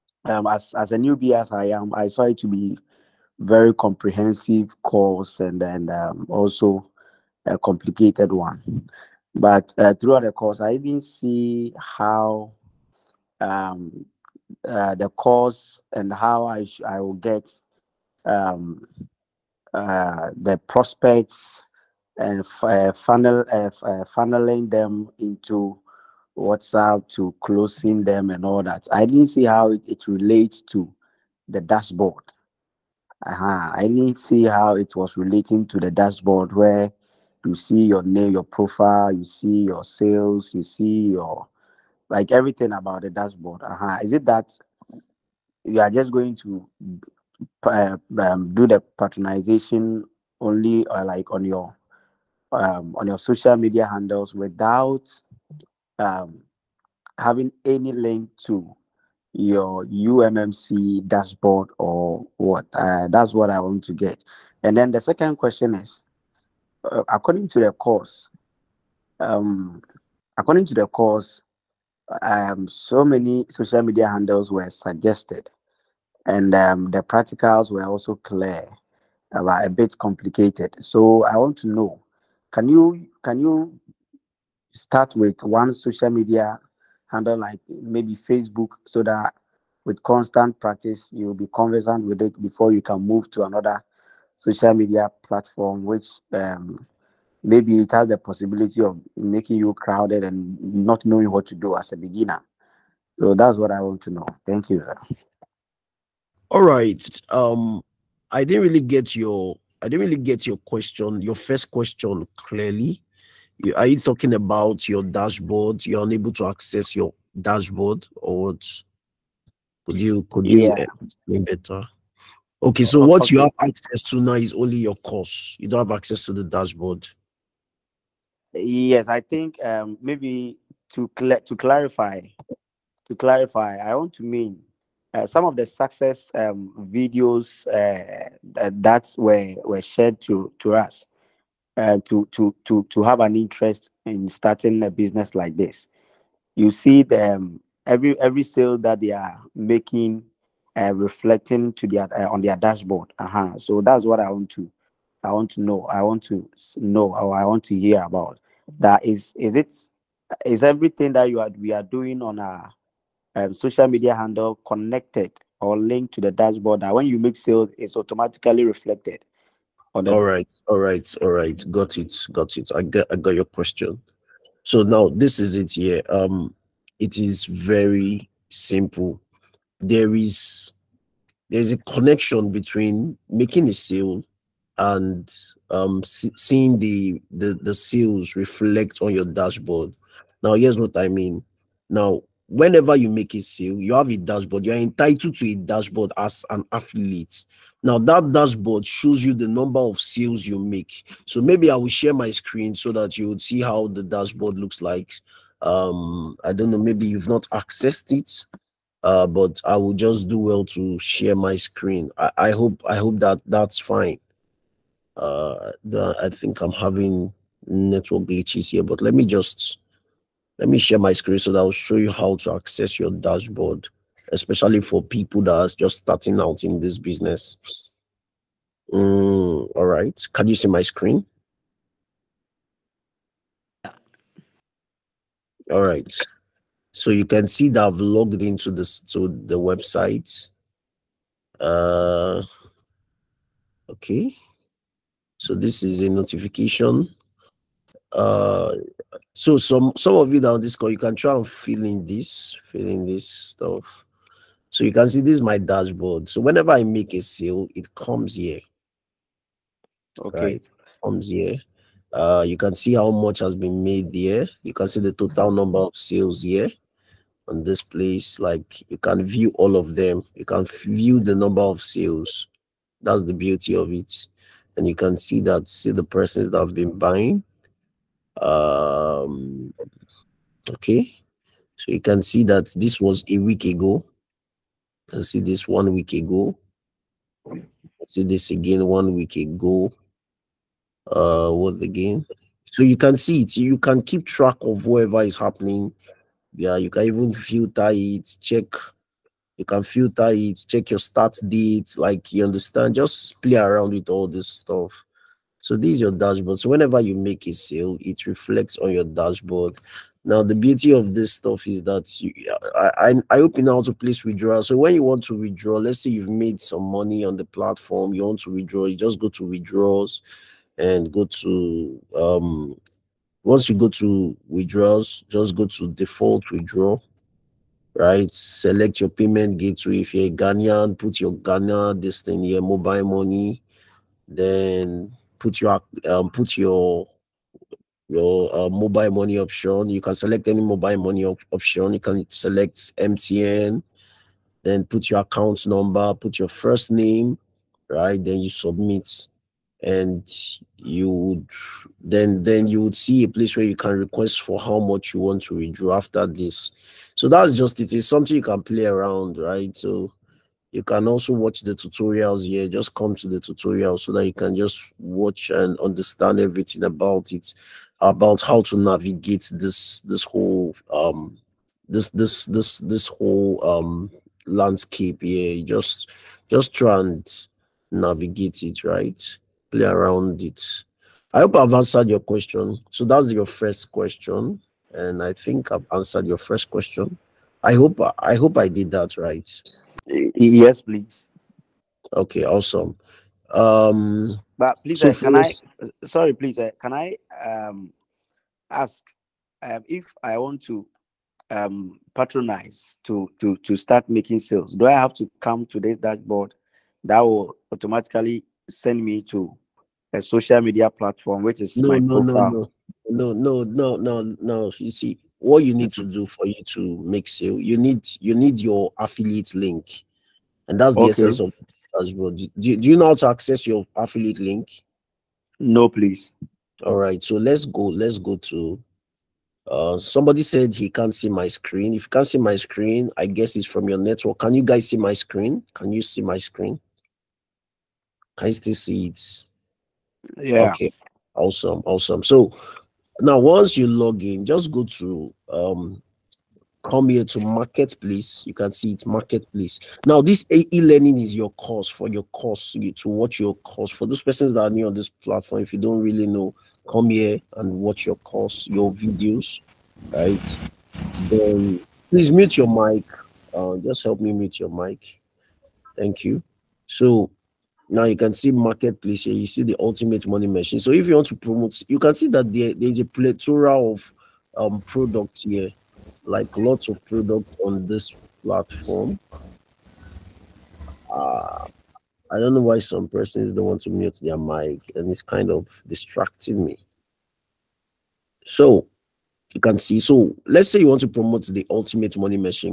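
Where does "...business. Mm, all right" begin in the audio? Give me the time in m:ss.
3:46.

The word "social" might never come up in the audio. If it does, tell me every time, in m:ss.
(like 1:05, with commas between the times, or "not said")
0:53, 1:13, 1:25, 1:34, 2:43, 6:50.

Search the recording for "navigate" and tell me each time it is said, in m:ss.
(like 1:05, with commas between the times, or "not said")
6:08, 6:17.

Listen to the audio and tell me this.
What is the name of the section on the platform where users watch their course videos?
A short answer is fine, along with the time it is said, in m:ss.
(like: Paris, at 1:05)
E-learning, at 7:30.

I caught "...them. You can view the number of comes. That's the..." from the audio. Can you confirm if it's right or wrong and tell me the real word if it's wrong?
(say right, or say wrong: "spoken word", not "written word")
wrong: "sales", not "comes".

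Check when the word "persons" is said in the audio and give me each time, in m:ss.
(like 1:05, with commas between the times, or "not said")
4:36, 7:34, 8:03.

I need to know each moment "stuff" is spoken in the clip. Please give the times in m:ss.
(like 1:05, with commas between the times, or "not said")
4:13, 5:04, 5:11.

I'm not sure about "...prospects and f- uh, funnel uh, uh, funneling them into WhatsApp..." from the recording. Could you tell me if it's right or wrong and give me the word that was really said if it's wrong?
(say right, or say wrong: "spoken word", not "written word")
right.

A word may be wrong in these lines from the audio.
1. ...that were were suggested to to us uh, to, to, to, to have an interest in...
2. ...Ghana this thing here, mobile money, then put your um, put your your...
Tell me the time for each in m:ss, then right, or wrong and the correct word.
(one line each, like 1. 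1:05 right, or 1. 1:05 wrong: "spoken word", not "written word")
1. 2:18 wrong: "shared", not "suggested"
2. 5:31 right.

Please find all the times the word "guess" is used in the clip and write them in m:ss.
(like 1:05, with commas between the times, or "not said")
7:13.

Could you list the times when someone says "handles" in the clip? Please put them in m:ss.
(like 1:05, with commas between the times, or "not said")
0:53, 1:14, 1:27, 2:44.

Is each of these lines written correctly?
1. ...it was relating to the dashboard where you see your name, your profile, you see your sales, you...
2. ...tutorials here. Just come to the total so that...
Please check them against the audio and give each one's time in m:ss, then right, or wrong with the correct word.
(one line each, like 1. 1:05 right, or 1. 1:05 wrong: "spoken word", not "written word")
1. 0:34 right
2. 6:01 wrong: "tutorial", not "total".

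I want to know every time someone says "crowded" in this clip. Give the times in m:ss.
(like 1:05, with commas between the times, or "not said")
1:39.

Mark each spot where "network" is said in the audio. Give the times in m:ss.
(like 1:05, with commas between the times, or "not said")
3:37, 7:13.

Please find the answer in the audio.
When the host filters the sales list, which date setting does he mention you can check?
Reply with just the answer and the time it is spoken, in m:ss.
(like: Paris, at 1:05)
Start date, at 5:00.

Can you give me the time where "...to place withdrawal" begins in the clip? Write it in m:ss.
5:13.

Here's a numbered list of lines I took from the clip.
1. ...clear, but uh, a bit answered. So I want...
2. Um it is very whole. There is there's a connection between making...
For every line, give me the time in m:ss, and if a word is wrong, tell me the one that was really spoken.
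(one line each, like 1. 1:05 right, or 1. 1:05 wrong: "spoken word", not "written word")
1. 1:18 wrong: "complicated", not "answered"
2. 2:56 wrong: "simple", not "whole".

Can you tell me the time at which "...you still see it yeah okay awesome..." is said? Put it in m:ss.
7:18.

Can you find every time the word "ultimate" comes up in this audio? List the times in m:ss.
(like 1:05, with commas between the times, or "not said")
7:49, 8:11.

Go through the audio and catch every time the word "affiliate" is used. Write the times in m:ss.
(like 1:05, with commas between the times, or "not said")
3:16, 6:58, 7:03.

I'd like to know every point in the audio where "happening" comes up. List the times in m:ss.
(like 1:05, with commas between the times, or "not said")
4:55.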